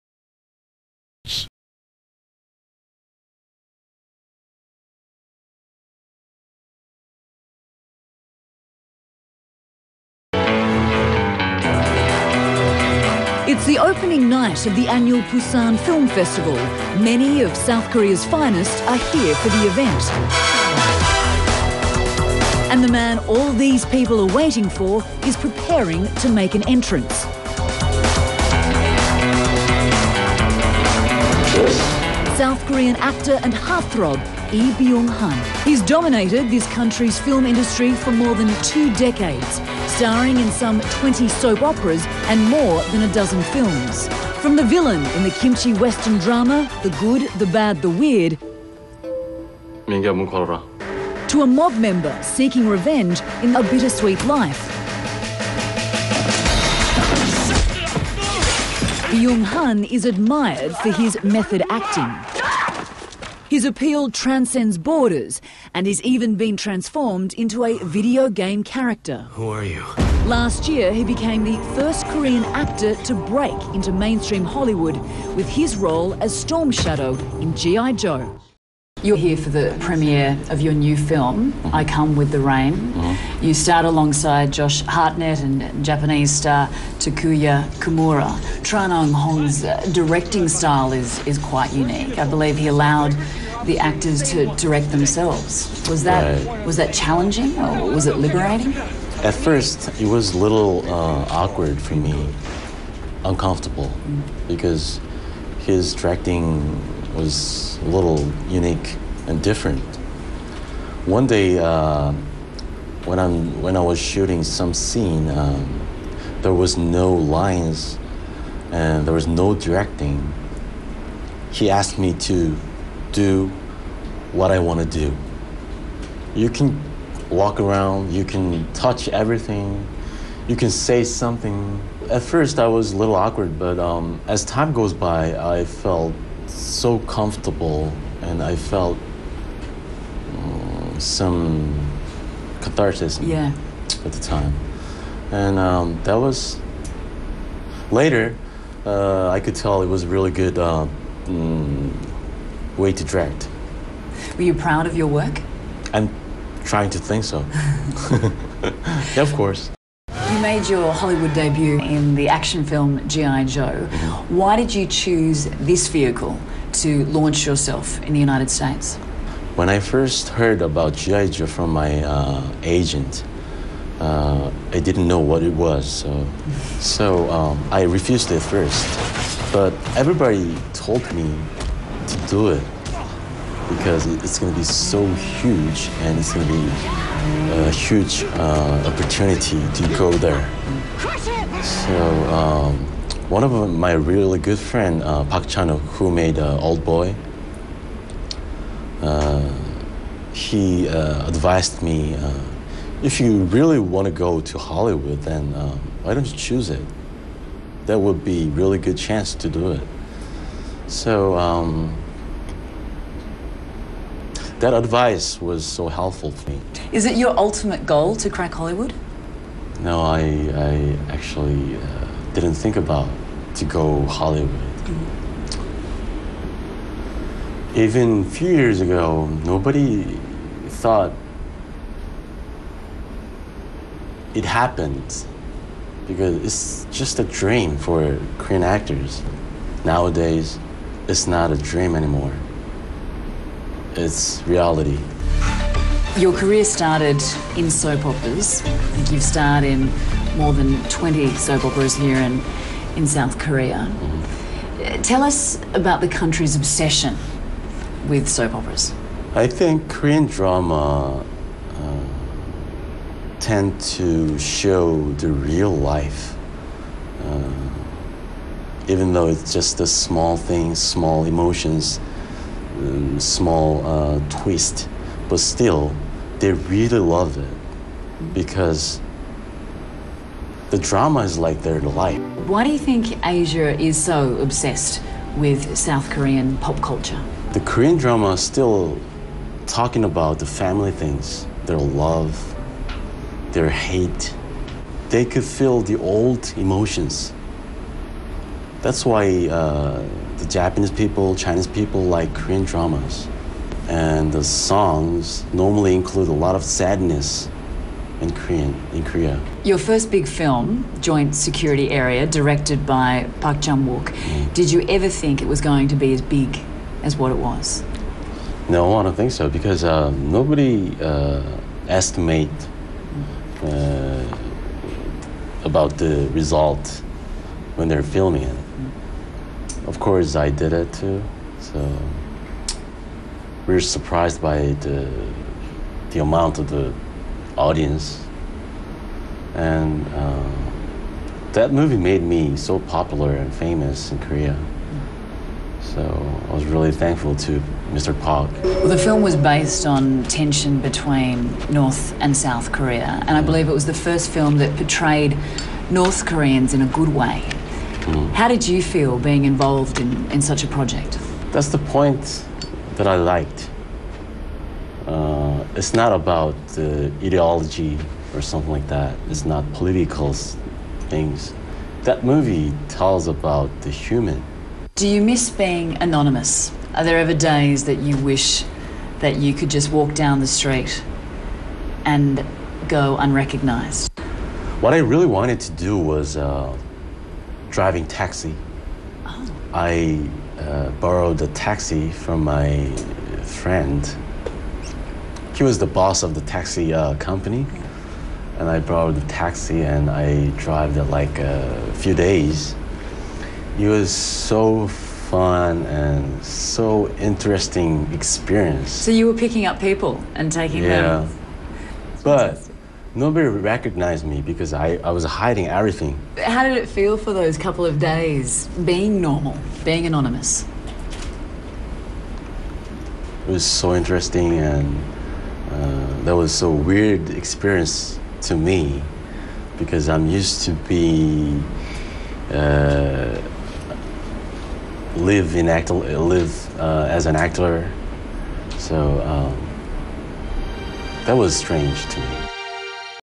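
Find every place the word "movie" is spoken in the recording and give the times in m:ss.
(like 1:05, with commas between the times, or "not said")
5:41, 6:12.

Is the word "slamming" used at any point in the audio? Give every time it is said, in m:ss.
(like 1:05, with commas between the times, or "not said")
not said.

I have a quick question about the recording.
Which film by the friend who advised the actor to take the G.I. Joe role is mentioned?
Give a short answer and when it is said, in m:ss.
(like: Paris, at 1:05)
Old Boy, at 3:16.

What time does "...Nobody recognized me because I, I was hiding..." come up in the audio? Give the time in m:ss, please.
6:53.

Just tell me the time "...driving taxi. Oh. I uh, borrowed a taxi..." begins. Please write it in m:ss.
6:27.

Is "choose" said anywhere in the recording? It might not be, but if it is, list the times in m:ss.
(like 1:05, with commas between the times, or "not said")
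2:44, 3:26.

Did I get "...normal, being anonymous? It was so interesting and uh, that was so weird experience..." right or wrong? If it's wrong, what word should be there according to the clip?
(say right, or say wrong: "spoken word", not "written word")
right.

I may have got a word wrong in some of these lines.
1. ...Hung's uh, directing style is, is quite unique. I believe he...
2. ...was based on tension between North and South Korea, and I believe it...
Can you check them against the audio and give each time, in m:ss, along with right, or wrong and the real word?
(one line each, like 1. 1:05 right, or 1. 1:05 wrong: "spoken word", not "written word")
1. 1:29 right
2. 5:49 right.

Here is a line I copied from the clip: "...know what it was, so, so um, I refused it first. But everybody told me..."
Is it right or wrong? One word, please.
right.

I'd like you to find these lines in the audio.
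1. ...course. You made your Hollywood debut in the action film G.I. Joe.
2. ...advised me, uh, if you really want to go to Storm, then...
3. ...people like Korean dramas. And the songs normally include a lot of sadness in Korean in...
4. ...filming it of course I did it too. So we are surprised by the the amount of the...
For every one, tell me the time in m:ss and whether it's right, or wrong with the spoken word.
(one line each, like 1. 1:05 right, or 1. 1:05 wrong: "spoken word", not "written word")
1. 2:39 right
2. 3:21 wrong: "Hollywood", not "Storm"
3. 5:01 right
4. 5:28 right.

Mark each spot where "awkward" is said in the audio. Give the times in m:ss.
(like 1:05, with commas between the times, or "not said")
1:41, 2:13.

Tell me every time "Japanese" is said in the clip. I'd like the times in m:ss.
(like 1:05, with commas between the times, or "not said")
1:25, 5:00.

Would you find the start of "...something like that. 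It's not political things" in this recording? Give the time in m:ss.
6:08.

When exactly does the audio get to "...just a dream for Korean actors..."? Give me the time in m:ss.
3:56.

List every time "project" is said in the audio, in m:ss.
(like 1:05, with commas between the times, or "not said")
6:00.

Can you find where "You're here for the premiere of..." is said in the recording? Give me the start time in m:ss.
1:19.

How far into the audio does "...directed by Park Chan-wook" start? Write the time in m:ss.
5:12.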